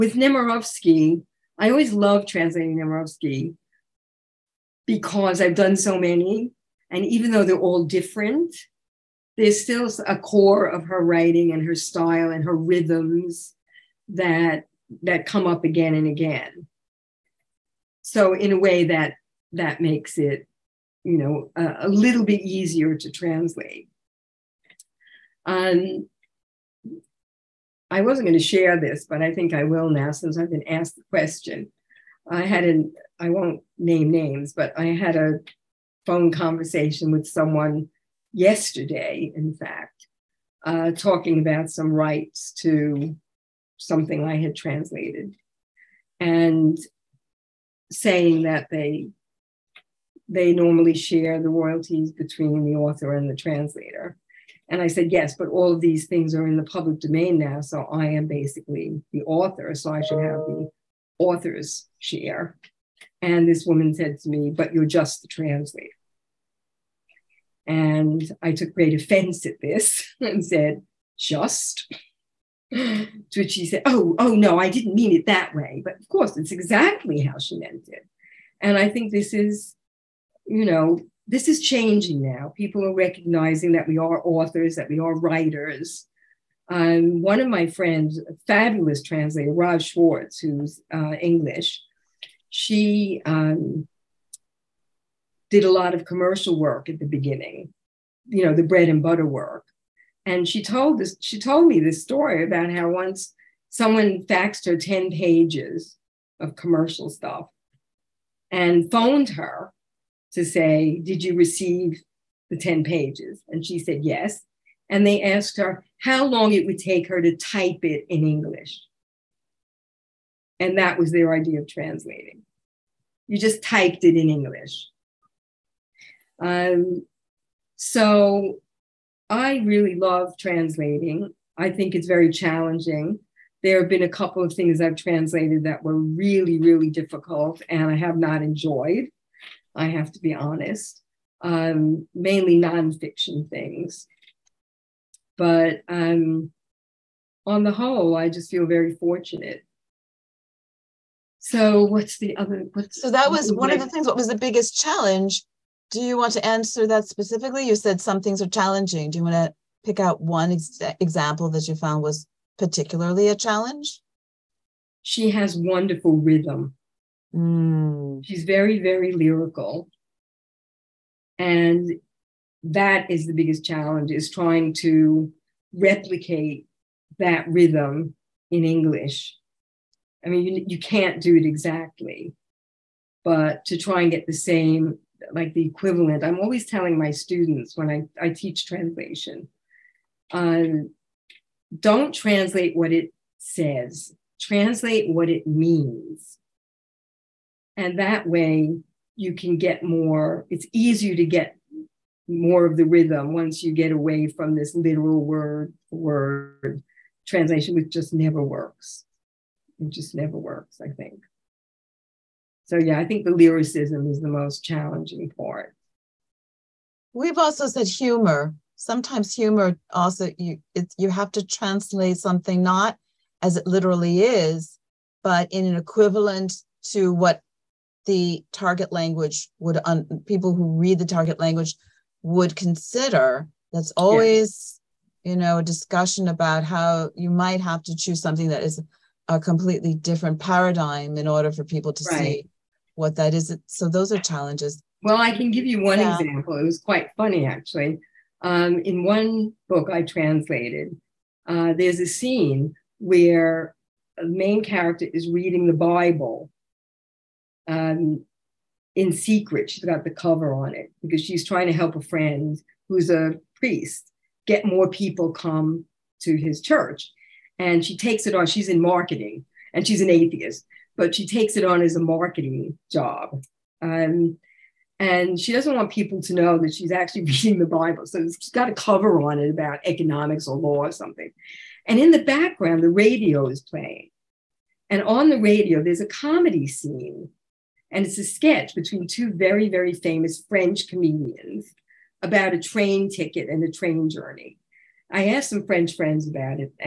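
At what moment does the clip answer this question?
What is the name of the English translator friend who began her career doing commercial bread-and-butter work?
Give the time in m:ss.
1:29.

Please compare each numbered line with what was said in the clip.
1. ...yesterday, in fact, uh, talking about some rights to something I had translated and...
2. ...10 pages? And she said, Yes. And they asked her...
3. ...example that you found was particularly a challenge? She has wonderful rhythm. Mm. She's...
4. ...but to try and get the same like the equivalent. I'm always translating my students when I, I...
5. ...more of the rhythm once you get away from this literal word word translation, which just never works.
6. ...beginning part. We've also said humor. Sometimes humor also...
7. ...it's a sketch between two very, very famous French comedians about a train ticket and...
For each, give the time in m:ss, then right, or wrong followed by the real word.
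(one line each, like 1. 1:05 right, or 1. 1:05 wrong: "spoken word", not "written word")
1. 0:38 right
2. 1:52 right
3. 2:40 right
4. 3:03 wrong: "telling", not "translating"
5. 3:22 right
6. 3:34 wrong: "challenging", not "beginning"
7. 4:48 right.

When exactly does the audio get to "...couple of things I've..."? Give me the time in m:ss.
2:14.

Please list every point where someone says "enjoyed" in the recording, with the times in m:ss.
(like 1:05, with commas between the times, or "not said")
2:18.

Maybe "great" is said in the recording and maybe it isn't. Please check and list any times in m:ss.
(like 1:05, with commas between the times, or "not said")
1:08.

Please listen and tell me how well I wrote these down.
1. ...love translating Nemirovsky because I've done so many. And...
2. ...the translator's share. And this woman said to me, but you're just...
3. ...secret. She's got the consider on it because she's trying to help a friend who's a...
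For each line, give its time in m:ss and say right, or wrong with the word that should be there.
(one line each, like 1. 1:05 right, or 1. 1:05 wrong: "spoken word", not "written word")
1. 0:01 right
2. 1:00 wrong: "author", not "translator"
3. 4:19 wrong: "cover", not "consider".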